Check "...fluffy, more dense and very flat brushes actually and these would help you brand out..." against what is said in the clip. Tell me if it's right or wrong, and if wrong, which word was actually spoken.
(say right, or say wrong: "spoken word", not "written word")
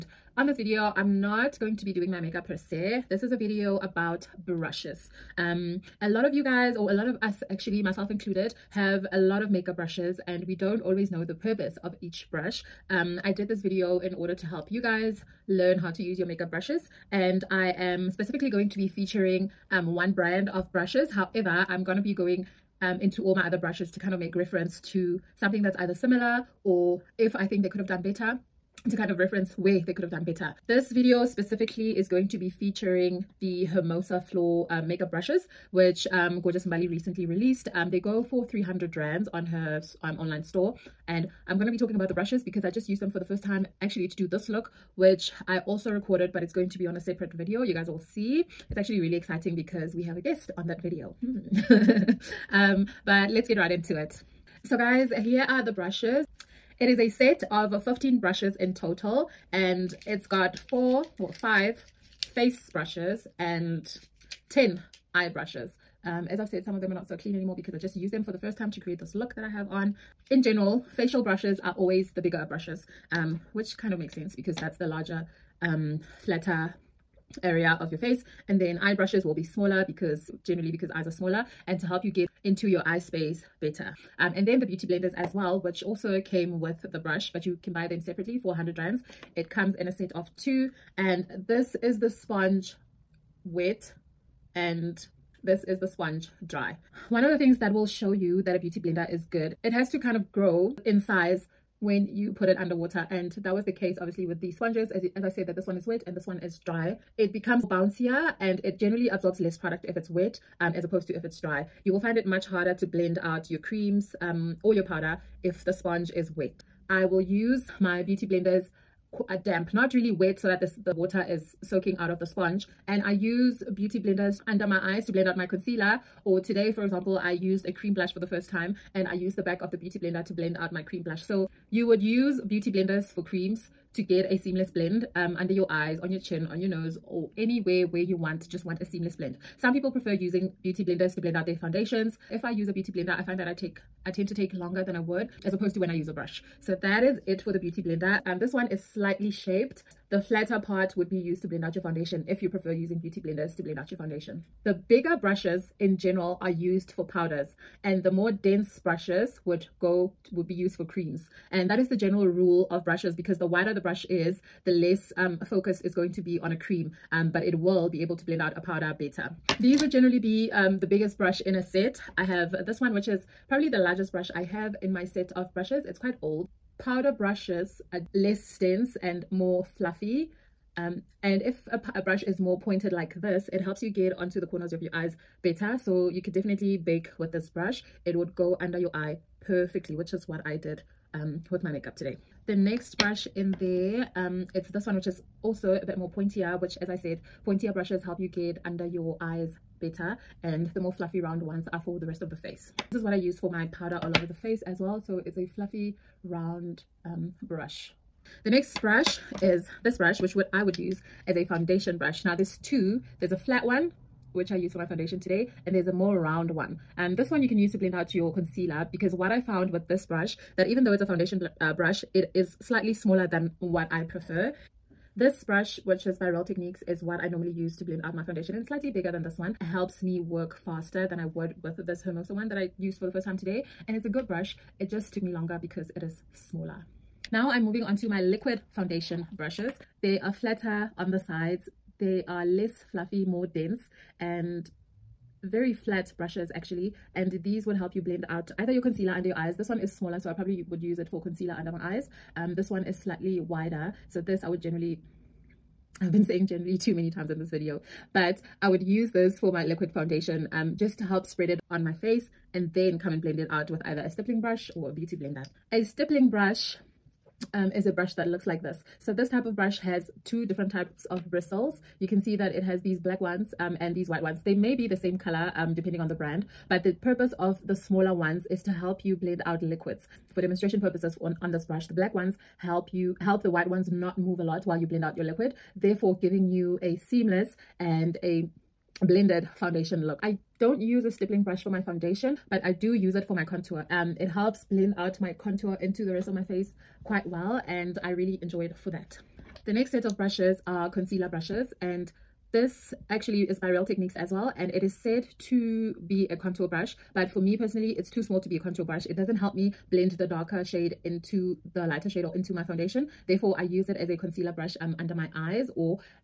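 wrong: "blend", not "brand".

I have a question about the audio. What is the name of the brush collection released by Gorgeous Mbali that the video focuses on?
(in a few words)
Hermosa Flor.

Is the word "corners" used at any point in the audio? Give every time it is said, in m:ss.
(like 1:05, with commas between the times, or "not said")
3:04.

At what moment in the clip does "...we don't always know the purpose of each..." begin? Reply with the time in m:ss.
0:10.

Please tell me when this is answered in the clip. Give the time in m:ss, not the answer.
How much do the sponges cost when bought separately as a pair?
1:28.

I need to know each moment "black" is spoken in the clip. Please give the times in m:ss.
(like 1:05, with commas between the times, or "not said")
4:32, 4:41.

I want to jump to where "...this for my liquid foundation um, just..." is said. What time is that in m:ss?
4:19.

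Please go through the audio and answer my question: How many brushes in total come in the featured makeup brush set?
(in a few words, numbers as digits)
15.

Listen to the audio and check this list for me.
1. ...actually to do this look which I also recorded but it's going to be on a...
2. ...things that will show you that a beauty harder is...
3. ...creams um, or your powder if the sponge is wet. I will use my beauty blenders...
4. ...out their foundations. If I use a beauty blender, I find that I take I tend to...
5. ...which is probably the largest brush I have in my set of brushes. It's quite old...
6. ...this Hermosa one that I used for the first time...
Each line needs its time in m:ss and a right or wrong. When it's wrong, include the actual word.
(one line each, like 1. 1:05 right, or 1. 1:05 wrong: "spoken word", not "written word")
1. 0:43 right
2. 1:37 wrong: "blender", not "harder"
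3. 1:53 right
4. 2:21 right
5. 2:52 right
6. 3:51 right.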